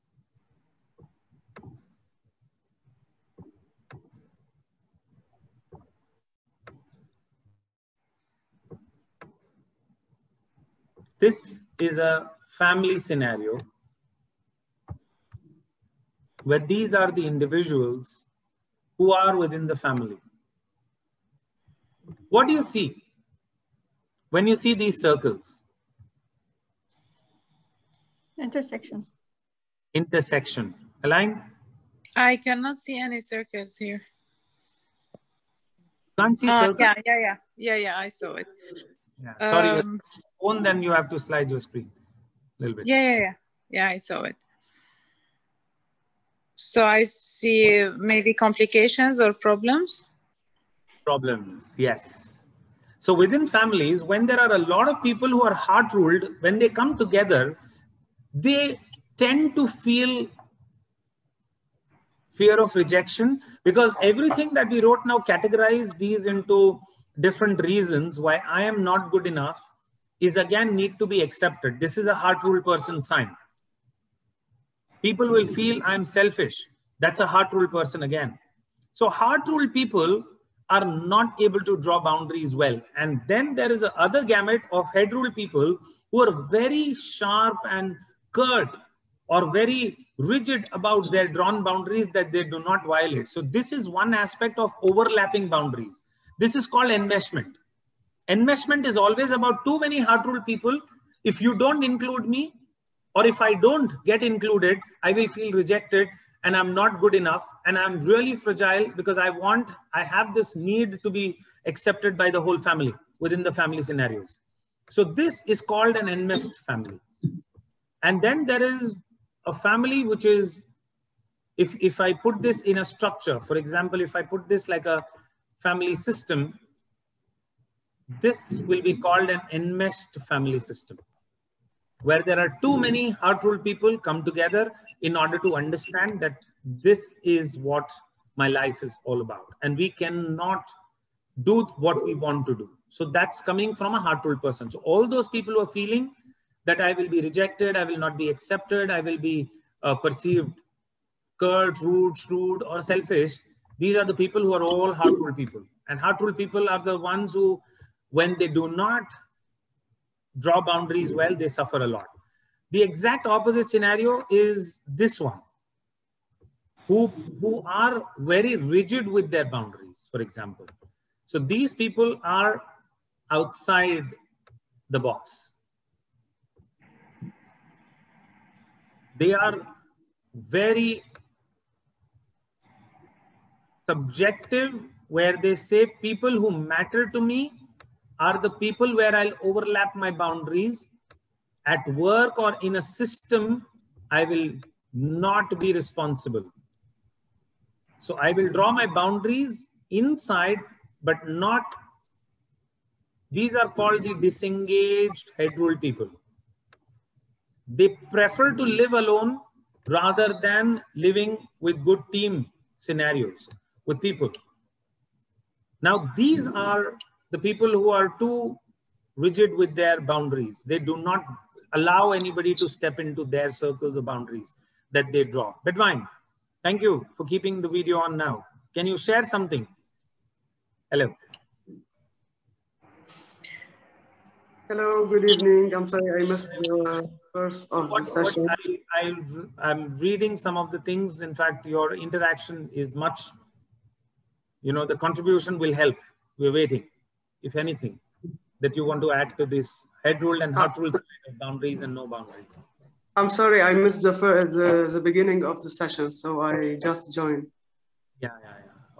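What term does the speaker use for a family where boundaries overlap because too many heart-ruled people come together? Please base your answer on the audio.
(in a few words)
Enmeshment.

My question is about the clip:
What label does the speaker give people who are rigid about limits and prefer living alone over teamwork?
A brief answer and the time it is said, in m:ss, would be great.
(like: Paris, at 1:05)
Disengaged head rule people, at 3:24.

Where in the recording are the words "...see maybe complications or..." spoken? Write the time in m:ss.
0:47.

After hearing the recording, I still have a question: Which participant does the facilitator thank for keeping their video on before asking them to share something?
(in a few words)
Bedwine.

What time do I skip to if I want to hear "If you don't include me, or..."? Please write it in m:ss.
1:41.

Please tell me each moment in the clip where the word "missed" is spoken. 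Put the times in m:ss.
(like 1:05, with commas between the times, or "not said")
3:56, 4:13.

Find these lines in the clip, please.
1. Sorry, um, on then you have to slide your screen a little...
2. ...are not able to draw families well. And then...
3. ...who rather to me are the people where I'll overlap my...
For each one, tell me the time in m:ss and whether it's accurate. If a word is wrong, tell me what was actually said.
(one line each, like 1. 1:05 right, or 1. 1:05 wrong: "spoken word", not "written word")
1. 0:39 right
2. 1:20 wrong: "boundaries", not "families"
3. 3:06 wrong: "matter", not "rather".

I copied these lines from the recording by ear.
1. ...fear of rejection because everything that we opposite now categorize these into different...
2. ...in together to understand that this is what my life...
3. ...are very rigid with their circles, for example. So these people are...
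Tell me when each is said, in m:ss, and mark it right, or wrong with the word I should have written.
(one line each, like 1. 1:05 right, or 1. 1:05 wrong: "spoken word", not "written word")
1. 1:02 wrong: "wrote", not "opposite"
2. 2:15 wrong: "order", not "together"
3. 2:47 wrong: "boundaries", not "circles".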